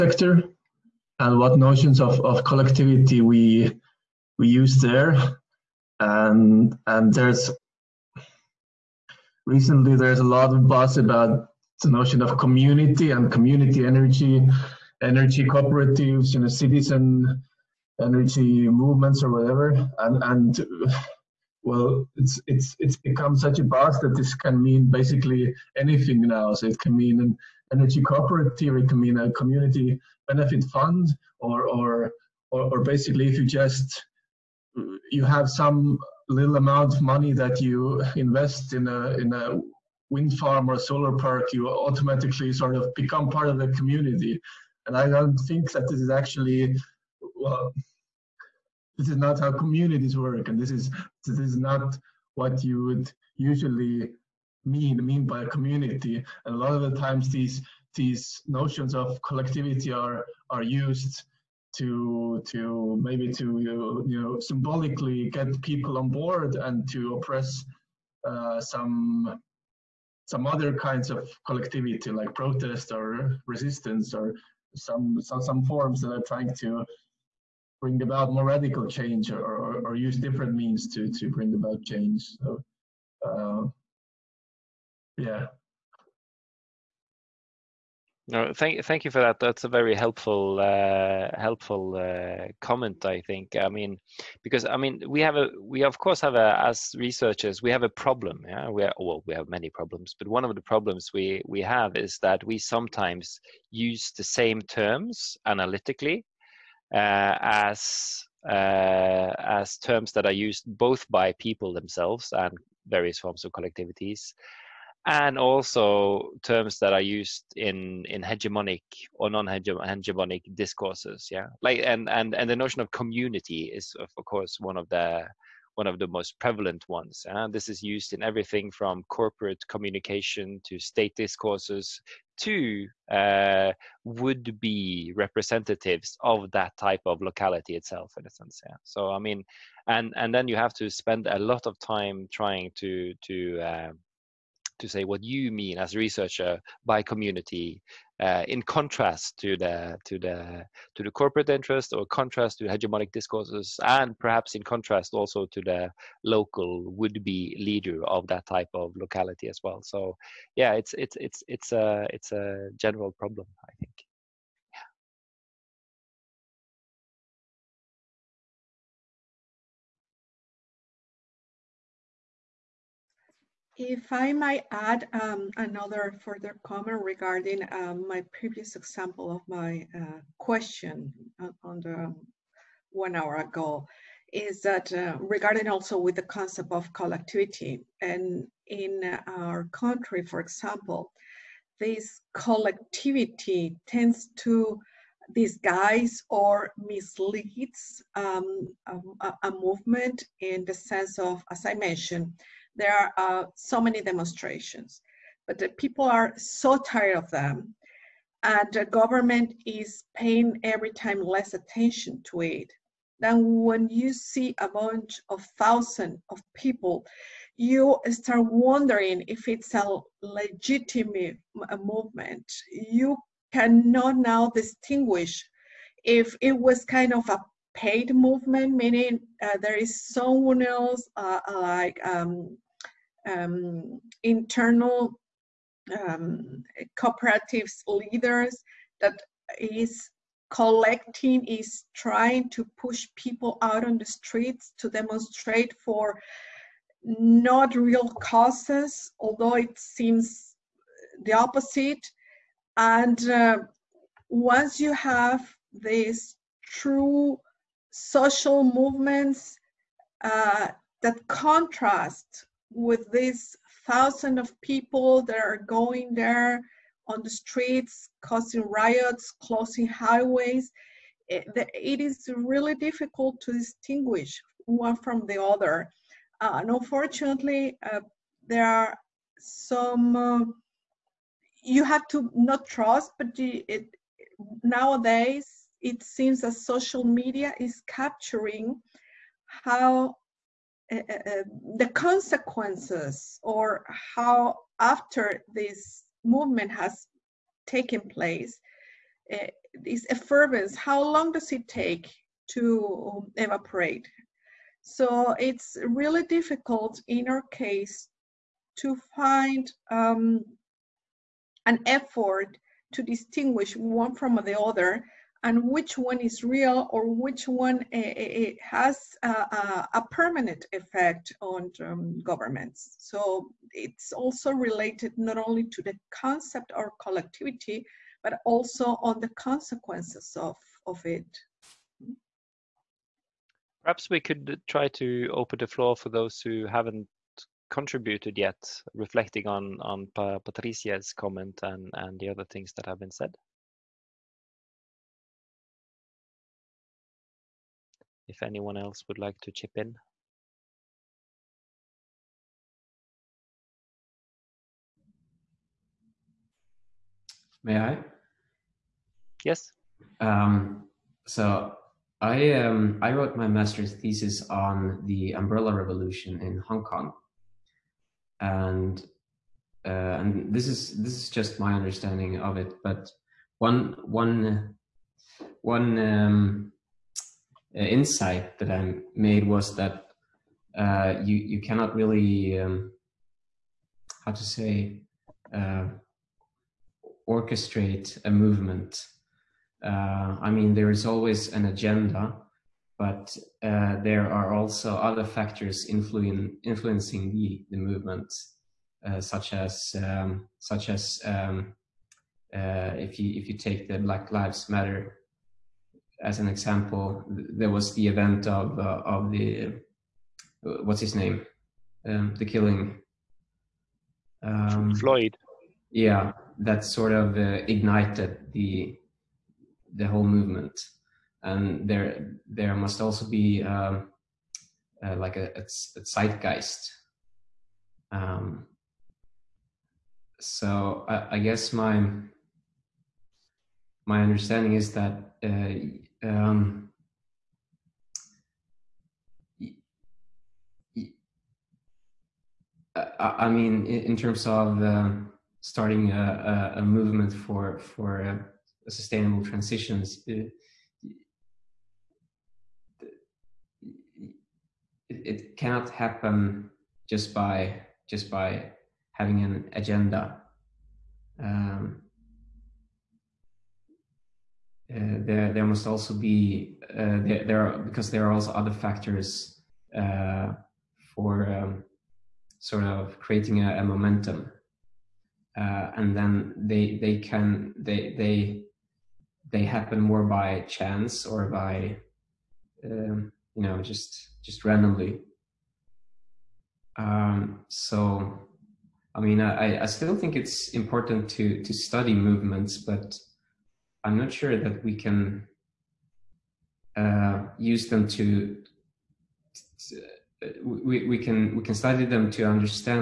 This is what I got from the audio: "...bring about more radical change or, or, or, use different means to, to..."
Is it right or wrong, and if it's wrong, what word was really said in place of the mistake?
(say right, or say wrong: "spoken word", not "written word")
right.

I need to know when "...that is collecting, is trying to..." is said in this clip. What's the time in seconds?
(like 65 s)
239 s.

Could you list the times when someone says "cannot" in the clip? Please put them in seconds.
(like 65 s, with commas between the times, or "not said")
223 s, 381 s, 455 s.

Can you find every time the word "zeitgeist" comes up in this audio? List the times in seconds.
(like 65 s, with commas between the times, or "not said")
426 s.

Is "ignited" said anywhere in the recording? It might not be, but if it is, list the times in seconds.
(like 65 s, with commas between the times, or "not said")
417 s.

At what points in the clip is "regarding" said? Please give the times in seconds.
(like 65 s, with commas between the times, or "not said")
177 s, 185 s.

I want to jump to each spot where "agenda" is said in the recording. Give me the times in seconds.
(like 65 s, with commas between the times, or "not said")
391 s, 459 s.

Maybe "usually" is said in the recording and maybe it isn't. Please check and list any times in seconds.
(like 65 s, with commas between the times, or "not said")
53 s.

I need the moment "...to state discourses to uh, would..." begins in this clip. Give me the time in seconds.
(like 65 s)
130 s.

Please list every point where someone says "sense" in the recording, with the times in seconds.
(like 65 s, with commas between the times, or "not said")
138 s, 200 s.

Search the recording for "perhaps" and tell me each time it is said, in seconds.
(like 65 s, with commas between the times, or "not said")
154 s, 333 s.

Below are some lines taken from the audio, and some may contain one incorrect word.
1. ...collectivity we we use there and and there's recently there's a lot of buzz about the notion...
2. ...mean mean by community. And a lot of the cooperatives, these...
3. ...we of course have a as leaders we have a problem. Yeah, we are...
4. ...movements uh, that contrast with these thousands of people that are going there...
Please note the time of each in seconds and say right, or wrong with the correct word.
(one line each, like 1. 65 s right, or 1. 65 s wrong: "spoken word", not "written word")
1. 2 s right
2. 54 s wrong: "times", not "cooperatives"
3. 95 s wrong: "researchers", not "leaders"
4. 258 s right.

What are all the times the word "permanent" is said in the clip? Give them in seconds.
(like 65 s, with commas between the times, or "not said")
320 s.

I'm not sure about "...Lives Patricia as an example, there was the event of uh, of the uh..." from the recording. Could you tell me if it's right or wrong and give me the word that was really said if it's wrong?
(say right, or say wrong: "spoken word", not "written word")
wrong: "Matter", not "Patricia".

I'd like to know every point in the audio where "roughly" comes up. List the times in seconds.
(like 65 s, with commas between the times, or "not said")
not said.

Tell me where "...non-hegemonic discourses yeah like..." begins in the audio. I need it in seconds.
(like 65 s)
119 s.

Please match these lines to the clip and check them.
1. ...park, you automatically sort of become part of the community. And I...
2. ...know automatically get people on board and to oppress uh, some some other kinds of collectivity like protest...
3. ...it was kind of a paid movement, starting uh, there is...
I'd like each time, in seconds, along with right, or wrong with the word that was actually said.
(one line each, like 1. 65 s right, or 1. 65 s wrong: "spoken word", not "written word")
1. 41 s right
2. 64 s wrong: "symbolically", not "automatically"
3. 226 s wrong: "meaning", not "starting".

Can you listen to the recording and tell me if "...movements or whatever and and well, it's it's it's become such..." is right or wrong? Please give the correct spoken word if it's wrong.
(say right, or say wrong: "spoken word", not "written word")
right.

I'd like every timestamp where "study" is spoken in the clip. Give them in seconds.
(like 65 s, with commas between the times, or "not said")
491 s, 501 s.